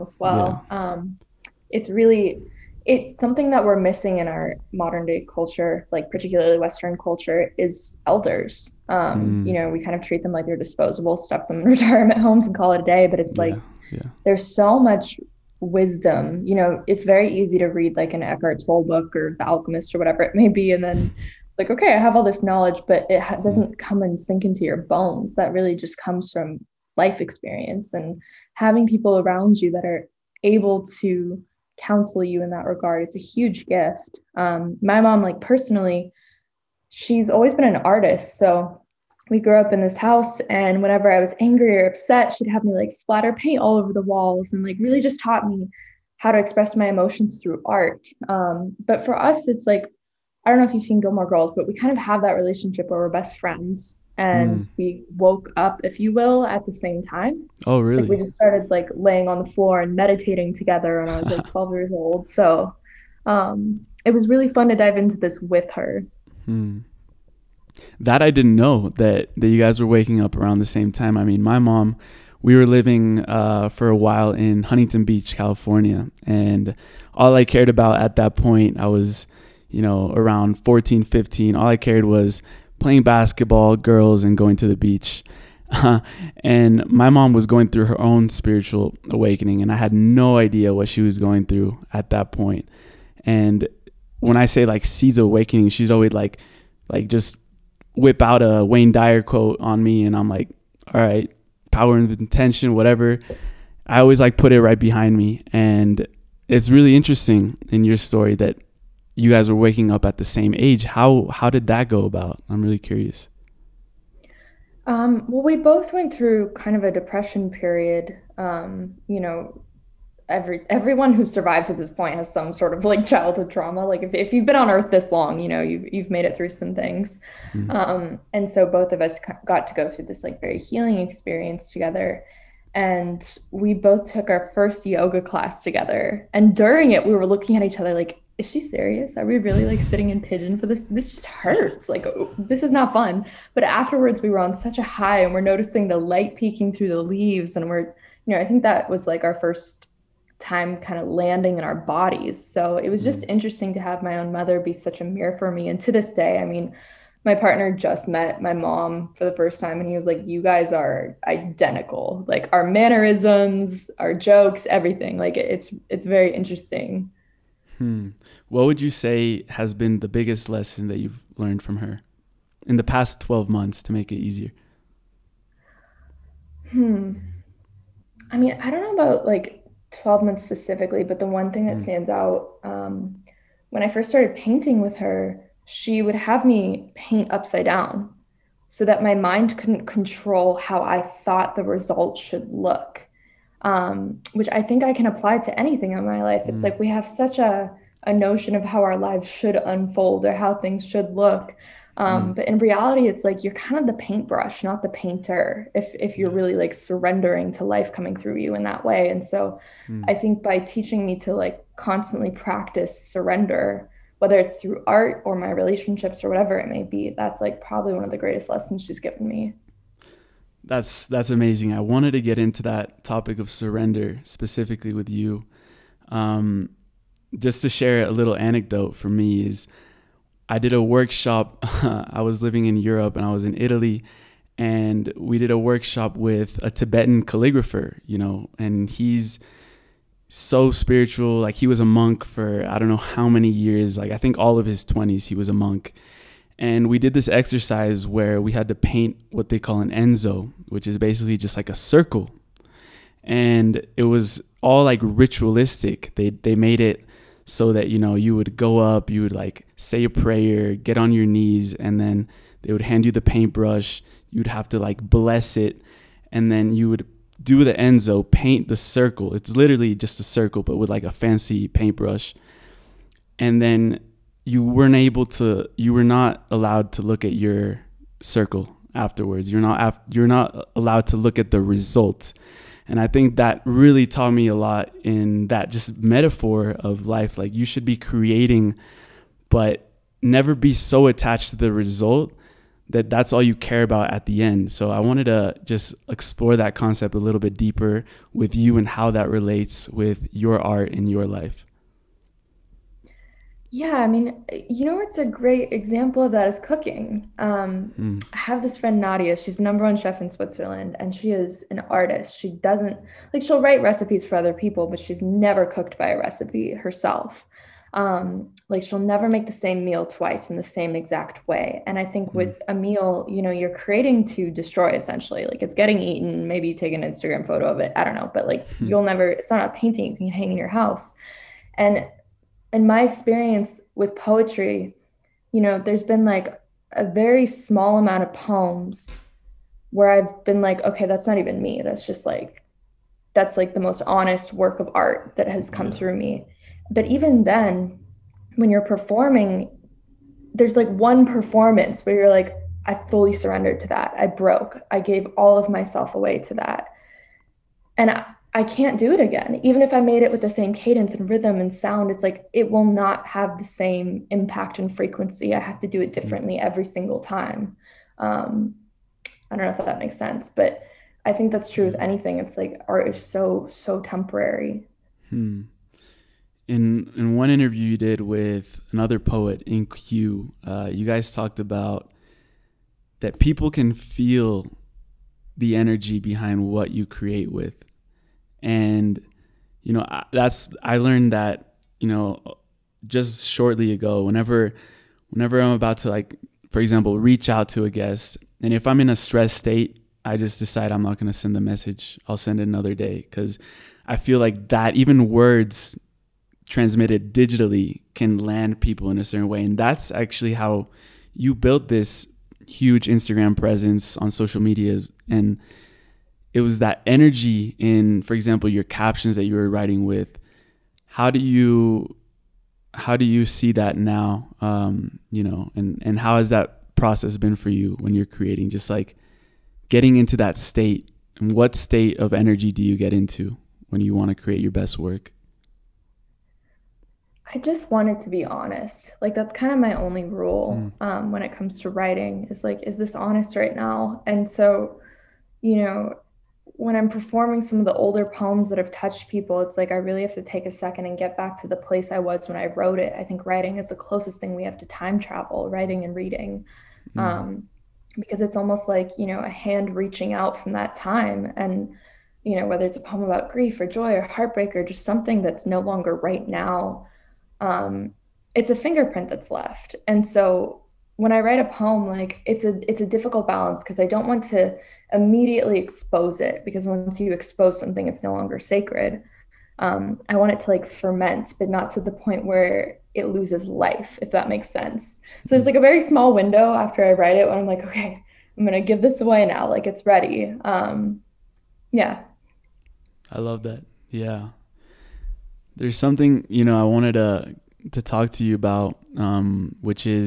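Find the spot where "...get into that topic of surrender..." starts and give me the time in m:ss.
3:42.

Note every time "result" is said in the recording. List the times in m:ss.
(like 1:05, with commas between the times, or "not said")
3:11, 4:41, 4:51.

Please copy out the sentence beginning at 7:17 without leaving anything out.
I just wanted to be honest.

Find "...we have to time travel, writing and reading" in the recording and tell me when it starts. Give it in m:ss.
7:34.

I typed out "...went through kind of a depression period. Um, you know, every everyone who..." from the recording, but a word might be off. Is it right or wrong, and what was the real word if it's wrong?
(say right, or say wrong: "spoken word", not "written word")
right.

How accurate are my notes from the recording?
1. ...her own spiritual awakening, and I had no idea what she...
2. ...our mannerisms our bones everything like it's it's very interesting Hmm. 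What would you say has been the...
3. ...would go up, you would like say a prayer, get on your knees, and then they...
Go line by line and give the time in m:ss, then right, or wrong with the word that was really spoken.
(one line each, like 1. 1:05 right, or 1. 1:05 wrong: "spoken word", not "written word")
1. 1:27 right
2. 2:42 wrong: "jokes", not "bones"
3. 4:18 right.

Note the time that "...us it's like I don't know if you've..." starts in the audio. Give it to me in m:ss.
0:49.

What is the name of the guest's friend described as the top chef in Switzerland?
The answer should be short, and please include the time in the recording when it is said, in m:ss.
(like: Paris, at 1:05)
Nadia, at 5:08.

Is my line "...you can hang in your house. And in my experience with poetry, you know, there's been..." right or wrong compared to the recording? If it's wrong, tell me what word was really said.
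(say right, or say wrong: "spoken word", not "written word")
right.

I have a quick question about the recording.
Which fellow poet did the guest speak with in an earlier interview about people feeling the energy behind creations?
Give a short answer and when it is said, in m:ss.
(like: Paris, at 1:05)
In-Q, at 6:19.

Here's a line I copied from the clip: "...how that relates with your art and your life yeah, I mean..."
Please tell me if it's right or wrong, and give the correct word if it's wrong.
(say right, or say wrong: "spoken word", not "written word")
right.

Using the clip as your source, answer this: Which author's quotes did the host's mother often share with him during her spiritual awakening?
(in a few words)
Wayne Dyer.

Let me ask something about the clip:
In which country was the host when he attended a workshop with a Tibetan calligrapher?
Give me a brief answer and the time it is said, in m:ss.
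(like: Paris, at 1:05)
Italy, at 3:53.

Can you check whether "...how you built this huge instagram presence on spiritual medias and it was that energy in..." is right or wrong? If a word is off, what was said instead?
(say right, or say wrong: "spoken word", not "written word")
wrong: "social", not "spiritual".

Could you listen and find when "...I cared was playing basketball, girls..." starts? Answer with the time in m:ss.
1:21.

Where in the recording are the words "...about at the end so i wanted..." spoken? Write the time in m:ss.
4:53.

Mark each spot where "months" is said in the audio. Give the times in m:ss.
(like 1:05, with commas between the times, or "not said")
2:53, 3:00.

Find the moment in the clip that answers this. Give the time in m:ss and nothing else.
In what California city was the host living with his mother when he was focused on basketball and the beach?
1:14.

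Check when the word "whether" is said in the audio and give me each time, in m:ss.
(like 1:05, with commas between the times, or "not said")
3:34, 7:42.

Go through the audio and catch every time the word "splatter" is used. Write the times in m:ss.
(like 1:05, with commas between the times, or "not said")
0:42.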